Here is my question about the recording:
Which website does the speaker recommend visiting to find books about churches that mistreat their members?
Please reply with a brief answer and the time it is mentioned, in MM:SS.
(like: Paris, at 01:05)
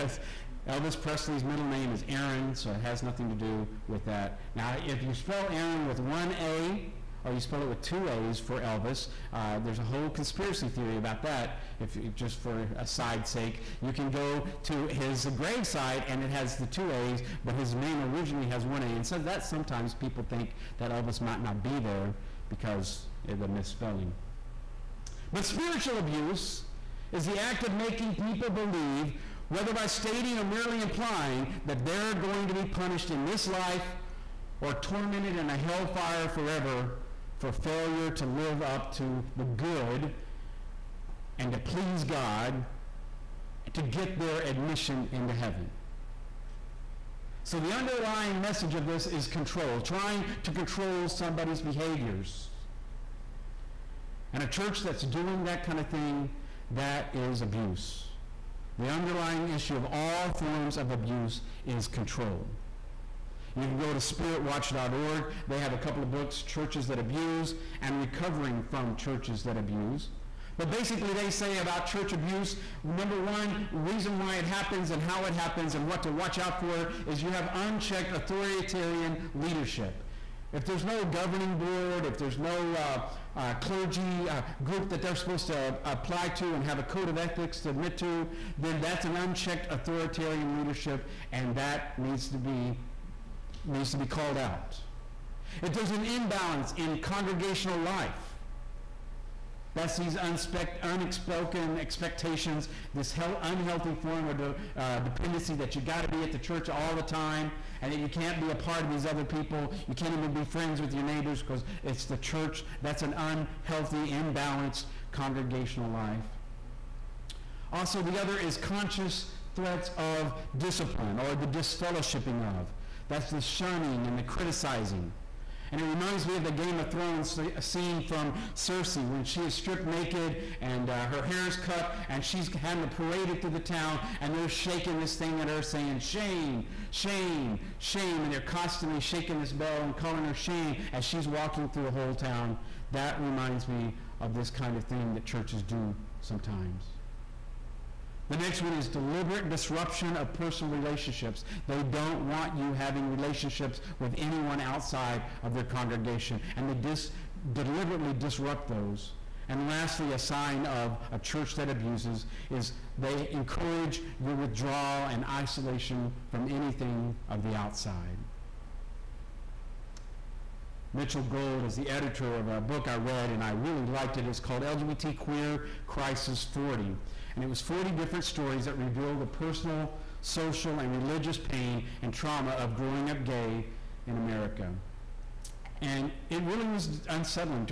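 spiritwatch.org, at 01:03.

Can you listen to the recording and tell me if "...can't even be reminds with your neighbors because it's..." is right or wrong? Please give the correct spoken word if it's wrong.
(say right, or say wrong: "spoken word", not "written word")
wrong: "friends", not "reminds".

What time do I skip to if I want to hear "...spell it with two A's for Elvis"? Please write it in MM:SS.
00:07.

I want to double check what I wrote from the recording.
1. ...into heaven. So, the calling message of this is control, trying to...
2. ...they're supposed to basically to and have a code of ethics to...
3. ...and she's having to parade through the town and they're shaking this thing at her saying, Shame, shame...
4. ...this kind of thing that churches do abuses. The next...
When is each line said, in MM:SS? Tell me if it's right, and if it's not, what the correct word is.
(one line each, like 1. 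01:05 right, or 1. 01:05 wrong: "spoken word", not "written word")
1. 00:45 wrong: "underlying", not "calling"
2. 01:25 wrong: "apply", not "basically"
3. 02:12 right
4. 02:24 wrong: "sometimes", not "abuses".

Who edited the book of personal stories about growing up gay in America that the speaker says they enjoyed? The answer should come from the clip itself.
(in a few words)
Mitchell Gold.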